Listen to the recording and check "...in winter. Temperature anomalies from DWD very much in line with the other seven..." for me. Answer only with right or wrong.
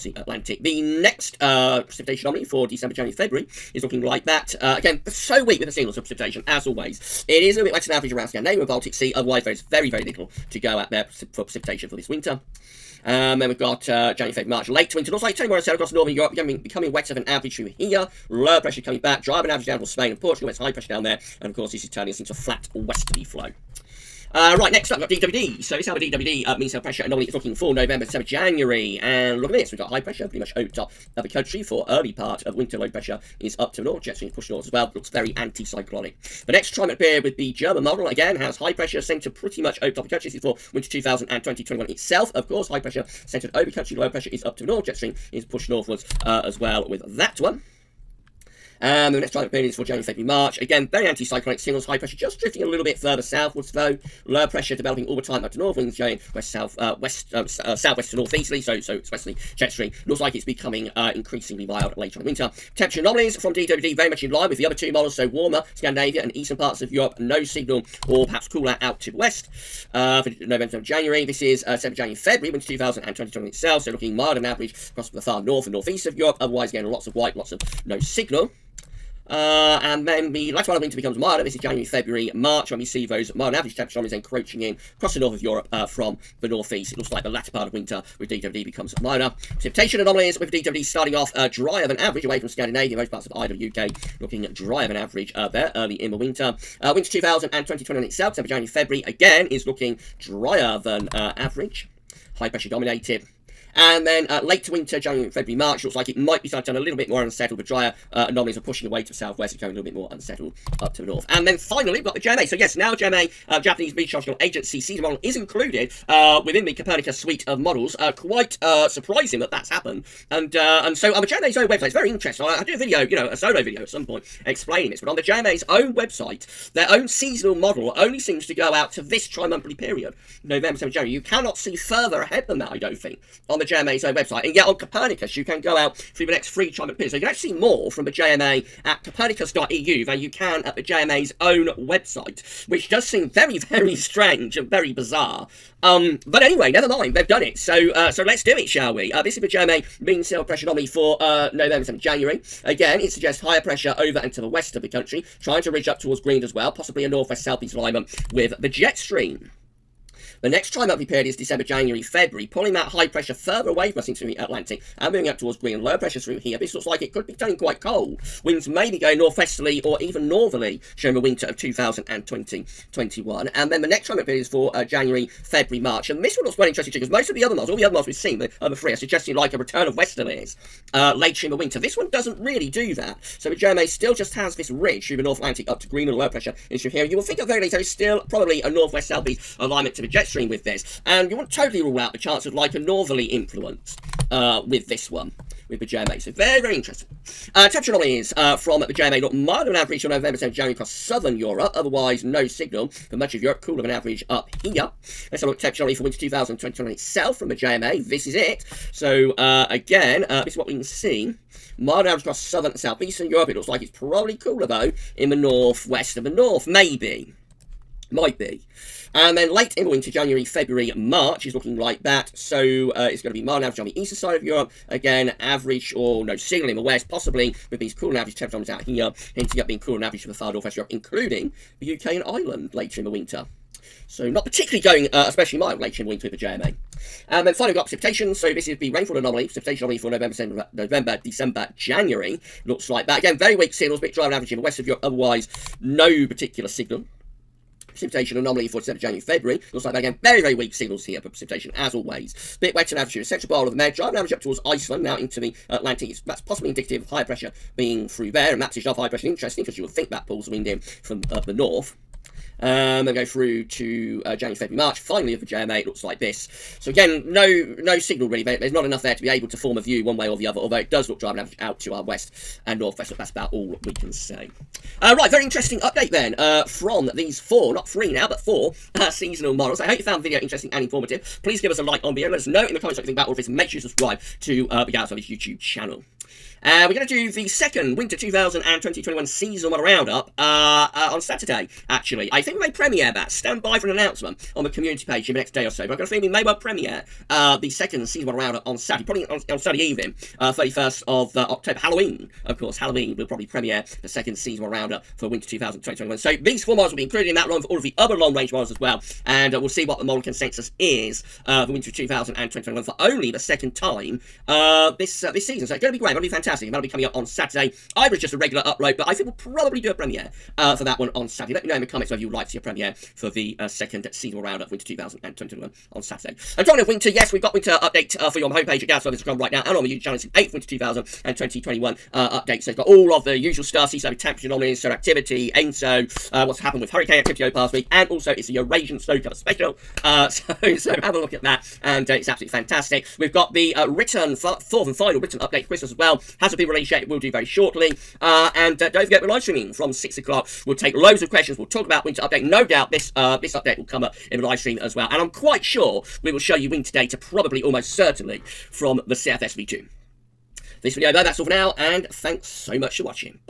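wrong.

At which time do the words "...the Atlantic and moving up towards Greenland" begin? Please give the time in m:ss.
2:44.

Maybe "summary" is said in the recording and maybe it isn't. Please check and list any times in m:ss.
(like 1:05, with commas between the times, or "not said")
not said.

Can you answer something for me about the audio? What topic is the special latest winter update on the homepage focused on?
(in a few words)
Eurasian snow cover.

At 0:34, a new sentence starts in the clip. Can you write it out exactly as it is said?
Jet stream pushed north as well.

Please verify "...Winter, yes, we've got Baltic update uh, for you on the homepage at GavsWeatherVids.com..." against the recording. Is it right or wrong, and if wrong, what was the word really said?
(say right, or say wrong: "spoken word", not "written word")
wrong: "Winter", not "Baltic".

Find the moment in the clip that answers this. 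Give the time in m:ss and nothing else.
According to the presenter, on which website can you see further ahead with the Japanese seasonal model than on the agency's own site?
2:19.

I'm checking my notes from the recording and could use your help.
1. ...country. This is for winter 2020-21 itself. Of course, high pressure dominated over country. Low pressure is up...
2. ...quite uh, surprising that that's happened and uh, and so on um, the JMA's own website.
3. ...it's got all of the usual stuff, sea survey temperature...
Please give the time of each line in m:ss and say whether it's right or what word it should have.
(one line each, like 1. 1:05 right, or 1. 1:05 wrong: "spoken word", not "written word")
1. 0:40 wrong: "centred", not "dominated"
2. 1:58 right
3. 5:32 right.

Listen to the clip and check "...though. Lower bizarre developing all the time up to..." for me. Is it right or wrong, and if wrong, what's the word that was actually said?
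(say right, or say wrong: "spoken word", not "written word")
wrong: "pressure", not "bizarre".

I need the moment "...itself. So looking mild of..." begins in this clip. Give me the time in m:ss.
1:13.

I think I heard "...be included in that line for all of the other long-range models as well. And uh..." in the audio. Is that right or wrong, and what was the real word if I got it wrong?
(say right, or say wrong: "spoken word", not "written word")
right.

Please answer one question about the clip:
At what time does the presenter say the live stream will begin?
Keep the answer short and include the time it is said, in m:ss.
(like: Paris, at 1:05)
6 o'clock, at 5:49.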